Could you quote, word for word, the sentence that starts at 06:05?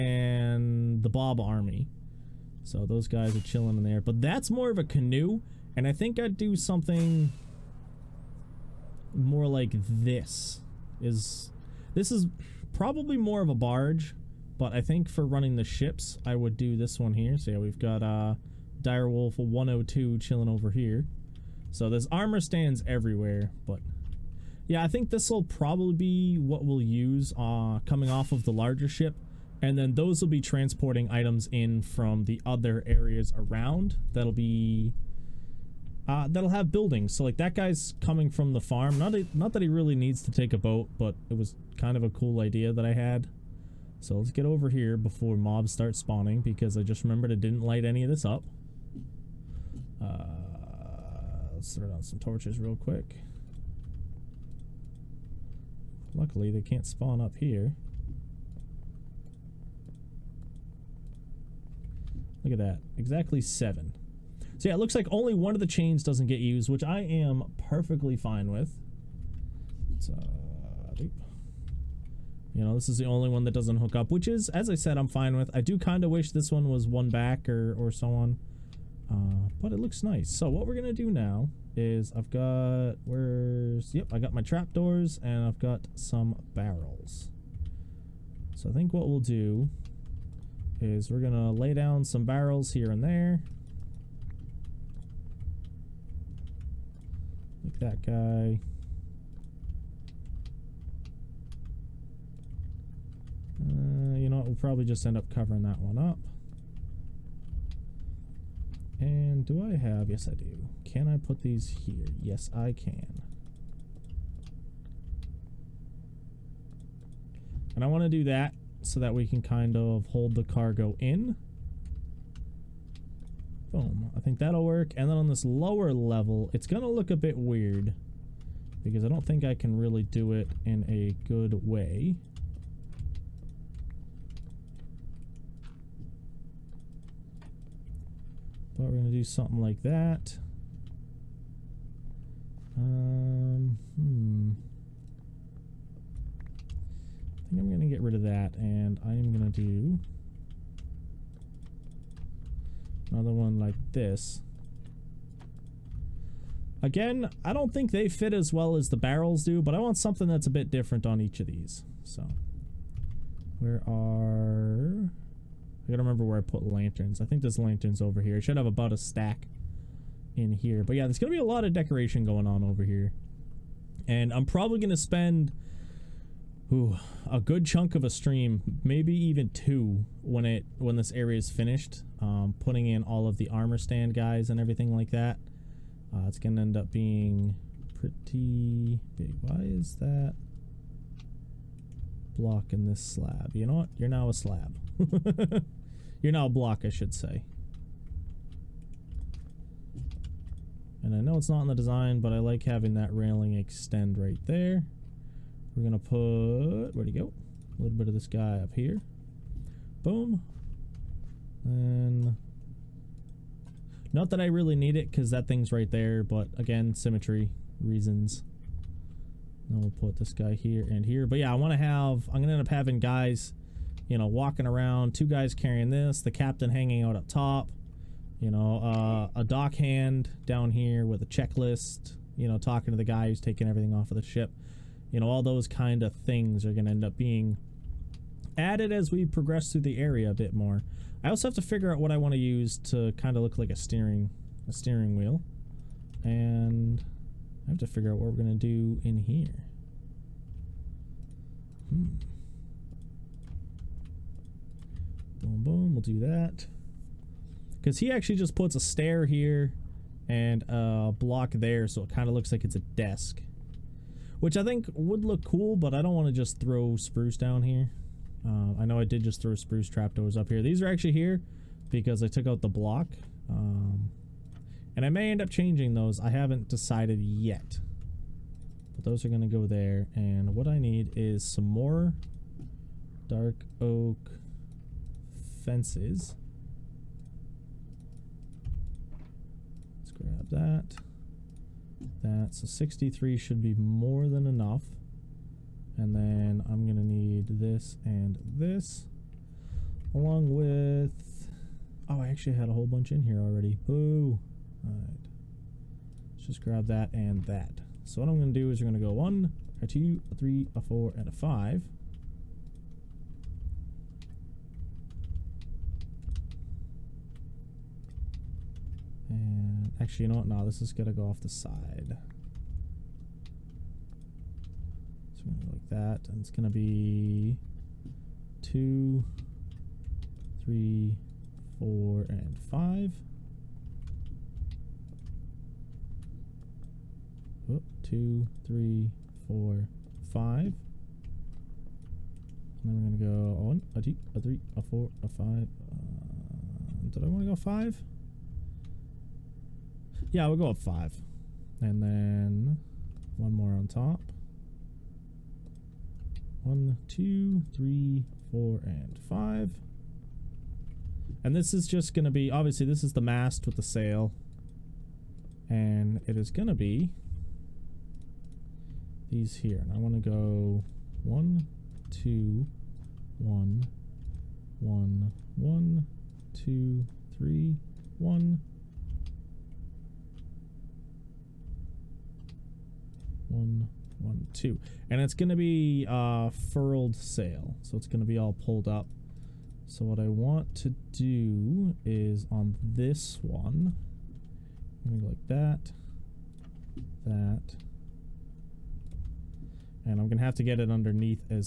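And it is going to be these here.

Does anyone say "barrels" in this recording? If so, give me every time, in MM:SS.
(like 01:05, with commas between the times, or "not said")
01:26, 01:32, 02:38.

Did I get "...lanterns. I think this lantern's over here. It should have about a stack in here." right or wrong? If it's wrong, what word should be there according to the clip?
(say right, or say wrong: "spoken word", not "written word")
right.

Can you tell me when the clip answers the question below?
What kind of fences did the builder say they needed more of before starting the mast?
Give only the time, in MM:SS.
04:43.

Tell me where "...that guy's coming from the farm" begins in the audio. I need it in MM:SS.
00:37.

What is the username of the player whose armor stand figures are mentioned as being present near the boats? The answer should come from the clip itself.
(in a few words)
direwolf 102.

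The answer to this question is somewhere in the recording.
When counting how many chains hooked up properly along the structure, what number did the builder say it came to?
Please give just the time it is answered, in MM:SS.
01:03.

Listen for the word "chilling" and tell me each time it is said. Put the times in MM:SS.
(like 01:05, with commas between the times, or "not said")
00:03, 00:20.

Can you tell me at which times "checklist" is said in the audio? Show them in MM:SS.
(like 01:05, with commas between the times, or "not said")
03:51.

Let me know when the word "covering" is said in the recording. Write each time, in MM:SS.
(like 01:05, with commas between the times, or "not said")
01:45.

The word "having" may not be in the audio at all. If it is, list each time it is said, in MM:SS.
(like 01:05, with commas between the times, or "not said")
03:22, 03:42.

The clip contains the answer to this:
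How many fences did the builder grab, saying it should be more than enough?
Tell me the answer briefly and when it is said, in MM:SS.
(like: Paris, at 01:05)
63, at 04:52.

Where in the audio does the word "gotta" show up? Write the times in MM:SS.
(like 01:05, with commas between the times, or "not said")
02:45.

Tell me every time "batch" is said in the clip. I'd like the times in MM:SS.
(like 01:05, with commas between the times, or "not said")
not said.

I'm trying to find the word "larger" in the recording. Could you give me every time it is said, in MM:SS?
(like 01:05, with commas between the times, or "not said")
00:28.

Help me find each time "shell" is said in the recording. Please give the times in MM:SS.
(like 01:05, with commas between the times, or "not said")
not said.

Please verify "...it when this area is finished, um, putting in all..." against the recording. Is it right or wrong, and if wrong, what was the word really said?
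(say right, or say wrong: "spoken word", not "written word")
right.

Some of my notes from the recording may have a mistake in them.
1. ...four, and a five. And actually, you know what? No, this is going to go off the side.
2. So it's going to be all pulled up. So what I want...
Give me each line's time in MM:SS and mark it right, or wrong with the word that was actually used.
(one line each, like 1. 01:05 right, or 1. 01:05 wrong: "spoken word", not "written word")
1. 05:10 right
2. 06:27 right.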